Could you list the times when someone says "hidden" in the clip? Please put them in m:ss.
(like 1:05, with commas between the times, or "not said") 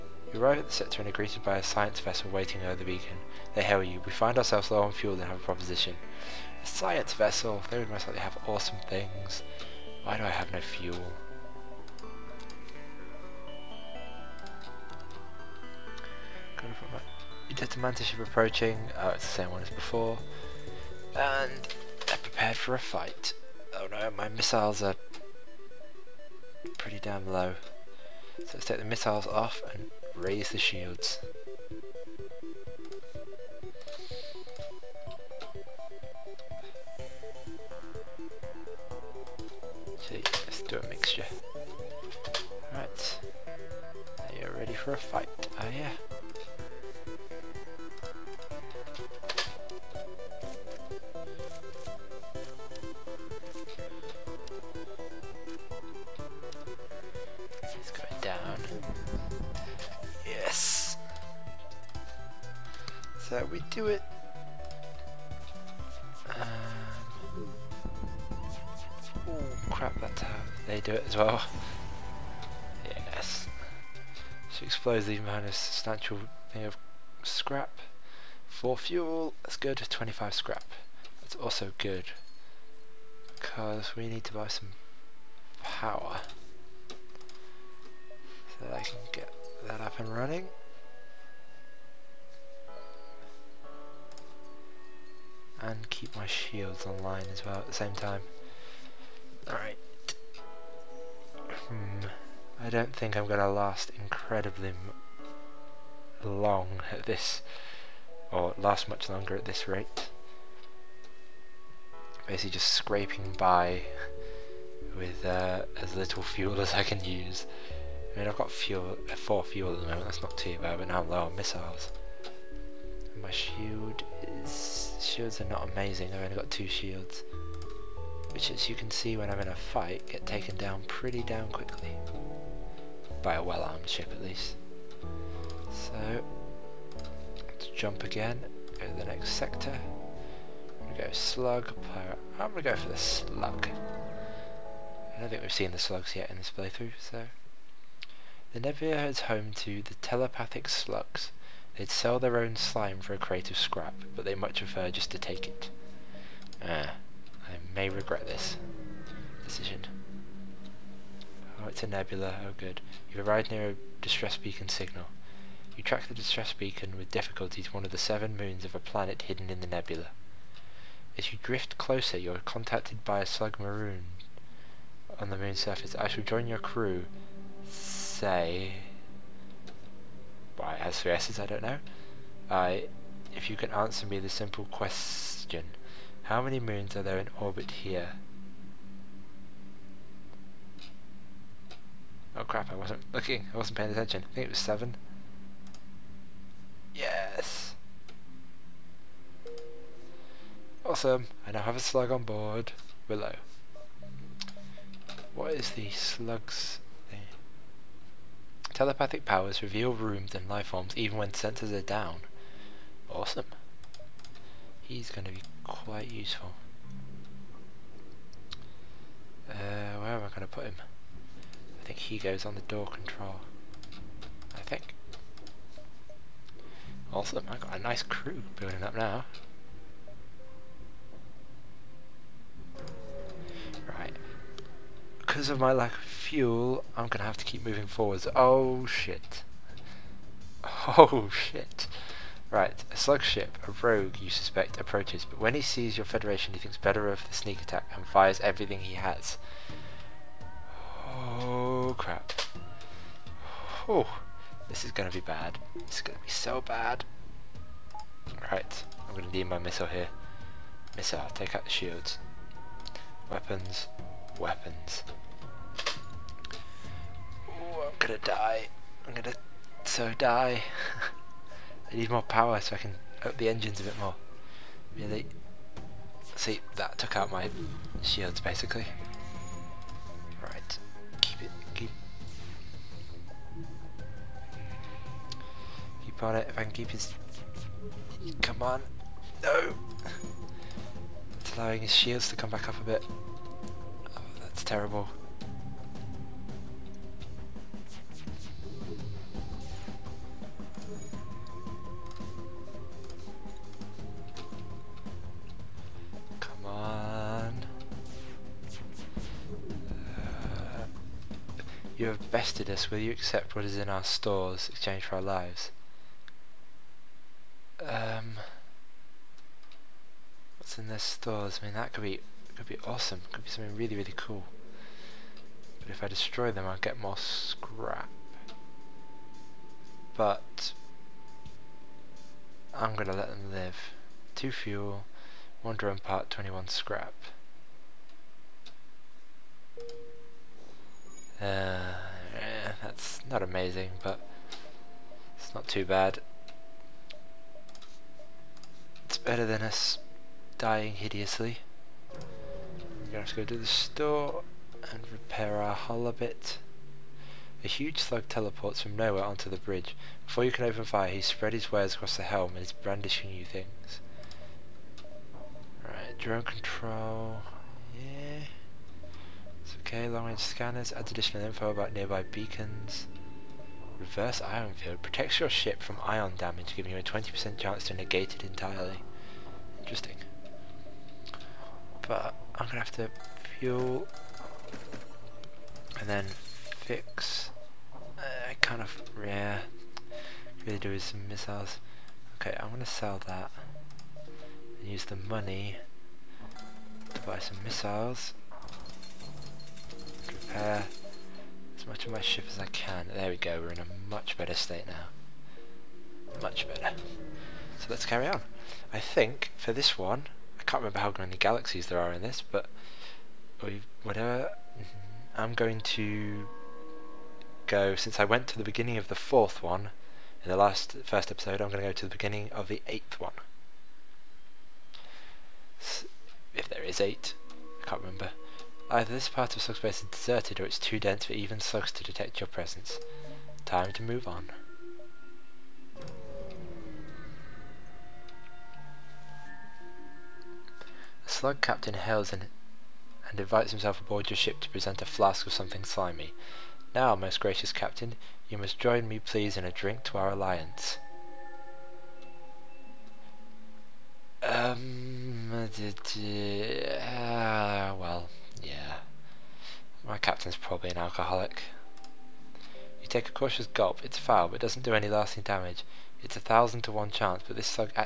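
2:49.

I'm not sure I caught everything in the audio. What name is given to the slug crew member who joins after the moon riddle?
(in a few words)
Willow.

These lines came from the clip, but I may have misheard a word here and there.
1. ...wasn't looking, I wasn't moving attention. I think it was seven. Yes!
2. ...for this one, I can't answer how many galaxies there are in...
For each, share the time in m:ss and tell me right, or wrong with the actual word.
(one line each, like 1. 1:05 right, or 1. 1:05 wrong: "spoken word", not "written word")
1. 3:12 wrong: "paying", not "moving"
2. 6:49 wrong: "remember", not "answer".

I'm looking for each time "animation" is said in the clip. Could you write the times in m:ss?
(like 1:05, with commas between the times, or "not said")
not said.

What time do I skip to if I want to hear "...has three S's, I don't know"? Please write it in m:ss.
3:00.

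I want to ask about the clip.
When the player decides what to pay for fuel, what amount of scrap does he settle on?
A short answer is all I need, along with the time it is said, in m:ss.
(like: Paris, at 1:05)
25 scrap, at 1:19.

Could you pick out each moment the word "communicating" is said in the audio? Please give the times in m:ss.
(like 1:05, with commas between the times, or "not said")
not said.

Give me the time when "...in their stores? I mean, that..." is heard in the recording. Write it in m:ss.
5:20.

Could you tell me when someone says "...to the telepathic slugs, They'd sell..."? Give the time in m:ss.
2:29.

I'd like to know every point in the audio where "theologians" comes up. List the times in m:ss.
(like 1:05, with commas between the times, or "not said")
not said.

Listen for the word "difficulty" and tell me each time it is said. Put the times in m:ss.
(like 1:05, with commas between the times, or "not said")
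2:47.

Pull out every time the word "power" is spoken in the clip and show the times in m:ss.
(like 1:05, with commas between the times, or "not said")
1:25, 3:29, 4:32.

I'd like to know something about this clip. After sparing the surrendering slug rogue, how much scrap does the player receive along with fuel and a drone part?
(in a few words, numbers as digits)
21 scrap.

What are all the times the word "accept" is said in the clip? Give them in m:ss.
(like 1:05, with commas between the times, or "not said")
5:13.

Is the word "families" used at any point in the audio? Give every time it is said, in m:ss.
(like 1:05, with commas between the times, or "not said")
not said.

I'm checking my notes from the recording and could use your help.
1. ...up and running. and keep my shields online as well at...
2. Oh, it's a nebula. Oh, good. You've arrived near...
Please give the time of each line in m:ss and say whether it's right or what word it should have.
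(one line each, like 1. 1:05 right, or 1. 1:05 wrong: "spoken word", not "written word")
1. 1:29 right
2. 2:41 right.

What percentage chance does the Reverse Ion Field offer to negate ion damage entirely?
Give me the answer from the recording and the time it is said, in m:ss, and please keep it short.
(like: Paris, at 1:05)
20%, at 6:17.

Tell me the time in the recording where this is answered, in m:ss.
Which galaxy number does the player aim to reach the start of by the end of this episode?
7:02.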